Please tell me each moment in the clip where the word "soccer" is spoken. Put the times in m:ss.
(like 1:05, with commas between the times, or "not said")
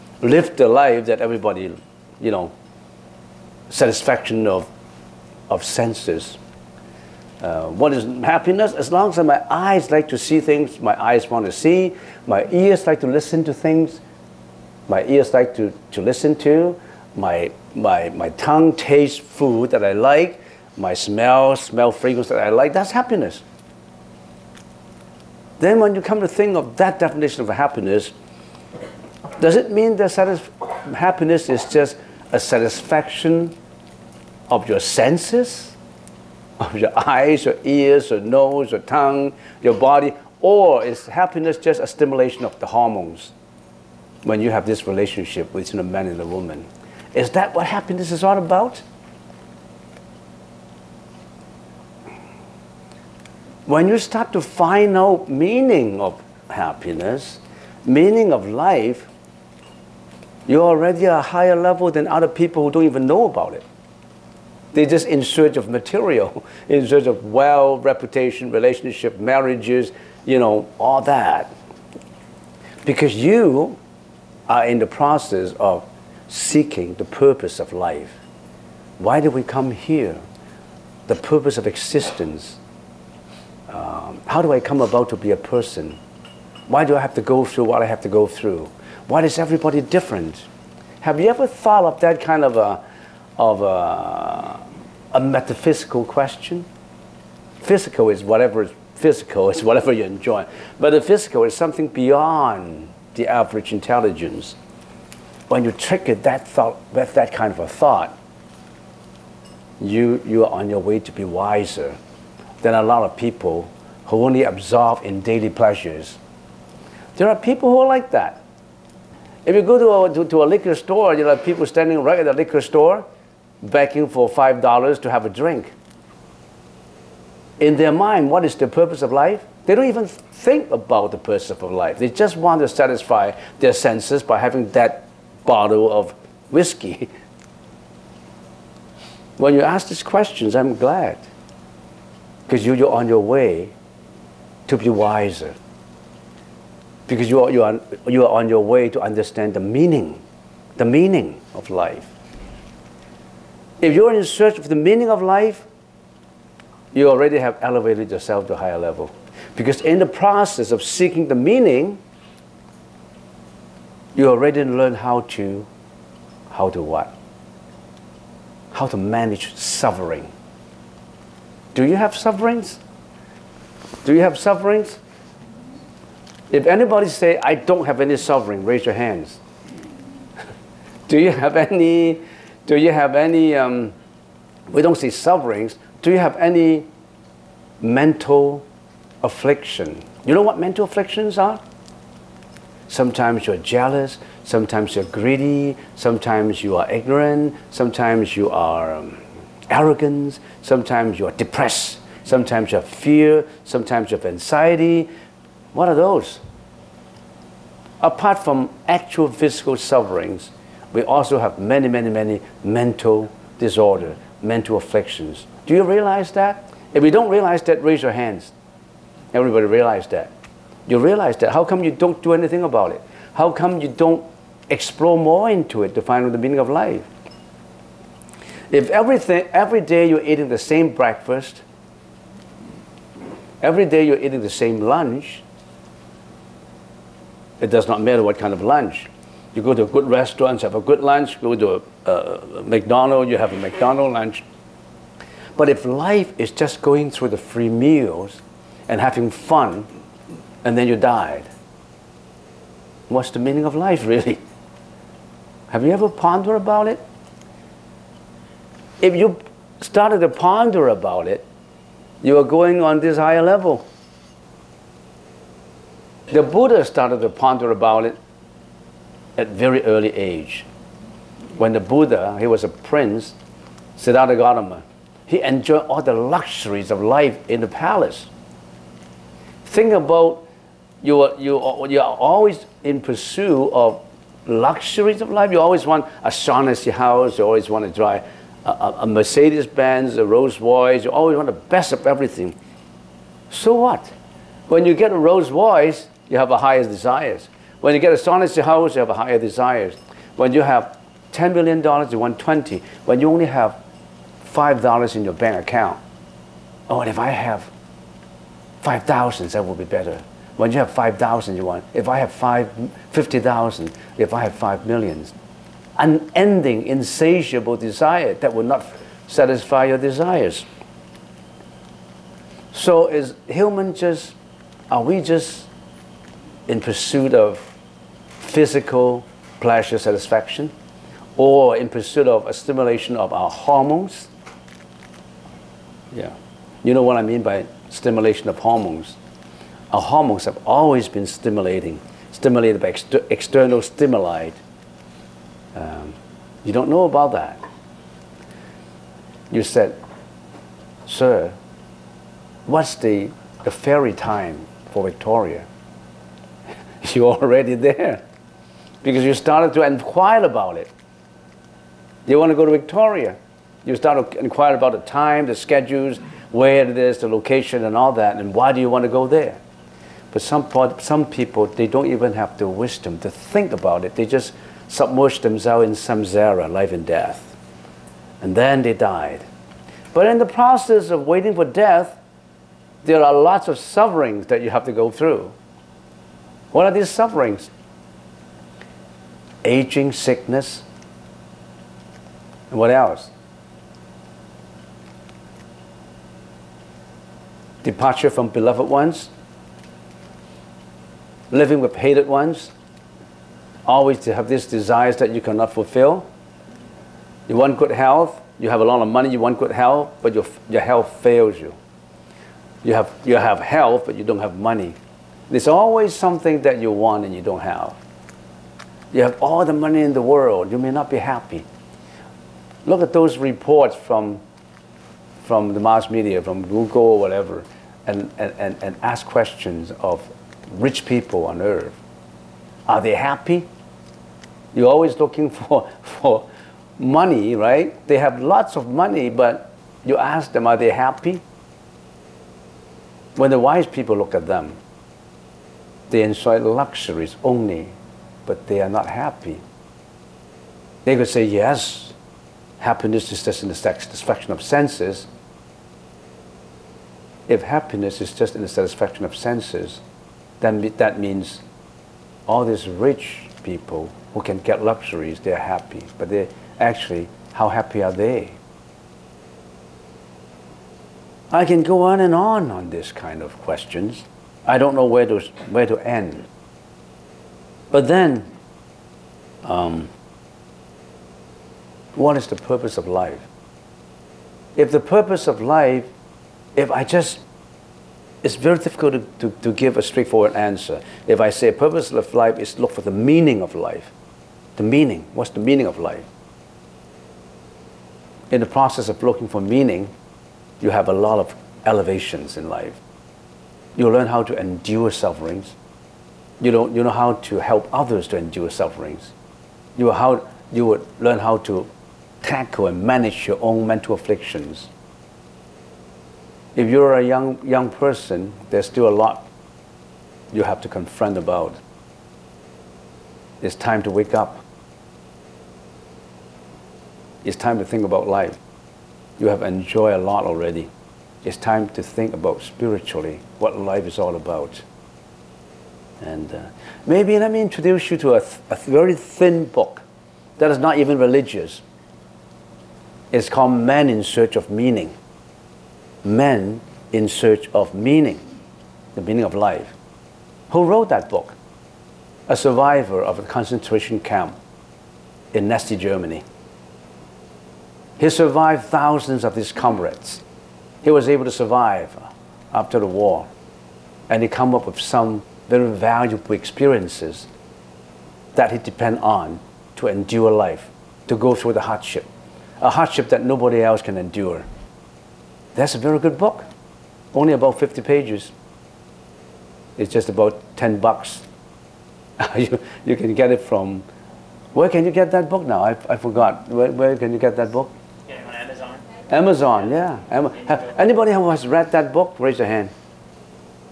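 not said.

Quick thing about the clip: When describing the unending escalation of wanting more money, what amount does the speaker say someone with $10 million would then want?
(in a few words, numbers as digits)
20 million.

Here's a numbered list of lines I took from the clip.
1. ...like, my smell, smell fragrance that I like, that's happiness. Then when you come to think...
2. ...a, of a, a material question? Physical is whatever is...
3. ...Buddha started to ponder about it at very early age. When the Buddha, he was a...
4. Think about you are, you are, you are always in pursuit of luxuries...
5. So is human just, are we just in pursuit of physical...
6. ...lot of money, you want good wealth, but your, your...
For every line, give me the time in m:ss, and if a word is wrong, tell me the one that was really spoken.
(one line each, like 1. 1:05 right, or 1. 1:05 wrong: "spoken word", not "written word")
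1. 0:19 right
2. 1:32 wrong: "metaphysical", not "material"
3. 4:26 right
4. 4:39 right
5. 5:22 right
6. 6:48 wrong: "health", not "wealth".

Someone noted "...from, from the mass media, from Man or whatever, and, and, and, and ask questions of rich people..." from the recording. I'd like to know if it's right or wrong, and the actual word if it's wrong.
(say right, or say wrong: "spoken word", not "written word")
wrong: "Google", not "Man".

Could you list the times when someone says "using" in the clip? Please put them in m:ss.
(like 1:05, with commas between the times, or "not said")
not said.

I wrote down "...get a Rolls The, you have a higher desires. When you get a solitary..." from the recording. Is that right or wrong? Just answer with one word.
wrong.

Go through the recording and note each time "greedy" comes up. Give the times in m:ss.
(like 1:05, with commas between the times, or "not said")
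3:15.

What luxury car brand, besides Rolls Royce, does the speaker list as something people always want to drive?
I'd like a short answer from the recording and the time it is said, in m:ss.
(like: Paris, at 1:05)
Mercedes Benz, at 4:49.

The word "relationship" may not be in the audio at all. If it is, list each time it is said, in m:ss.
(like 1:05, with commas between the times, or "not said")
0:44, 1:08.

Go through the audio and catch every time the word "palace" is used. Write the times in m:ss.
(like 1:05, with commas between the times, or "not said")
4:37.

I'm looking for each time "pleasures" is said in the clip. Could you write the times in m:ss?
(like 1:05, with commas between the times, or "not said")
1:55, 5:29.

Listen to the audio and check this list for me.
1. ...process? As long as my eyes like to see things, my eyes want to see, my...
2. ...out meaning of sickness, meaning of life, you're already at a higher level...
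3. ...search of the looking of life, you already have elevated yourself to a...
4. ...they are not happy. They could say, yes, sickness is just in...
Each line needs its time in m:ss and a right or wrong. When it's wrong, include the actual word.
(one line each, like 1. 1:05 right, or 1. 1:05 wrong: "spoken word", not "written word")
1. 0:08 wrong: "happiness", not "process"
2. 0:54 wrong: "happiness", not "sickness"
3. 2:34 wrong: "meaning", not "looking"
4. 7:28 wrong: "happiness", not "sickness".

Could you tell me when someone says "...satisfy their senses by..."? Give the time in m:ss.
2:12.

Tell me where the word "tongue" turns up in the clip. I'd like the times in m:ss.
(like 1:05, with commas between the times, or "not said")
0:18, 0:38.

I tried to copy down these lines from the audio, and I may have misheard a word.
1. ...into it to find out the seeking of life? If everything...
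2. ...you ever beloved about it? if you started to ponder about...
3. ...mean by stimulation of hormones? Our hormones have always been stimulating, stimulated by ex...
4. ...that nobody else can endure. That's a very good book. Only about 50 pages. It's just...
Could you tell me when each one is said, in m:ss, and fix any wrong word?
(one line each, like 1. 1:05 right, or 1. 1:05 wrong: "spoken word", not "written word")
1. 3:45 wrong: "meaning", not "seeking"
2. 4:15 wrong: "pondered", not "beloved"
3. 5:37 right
4. 9:33 right.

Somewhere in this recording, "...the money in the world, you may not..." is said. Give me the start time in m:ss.
6:59.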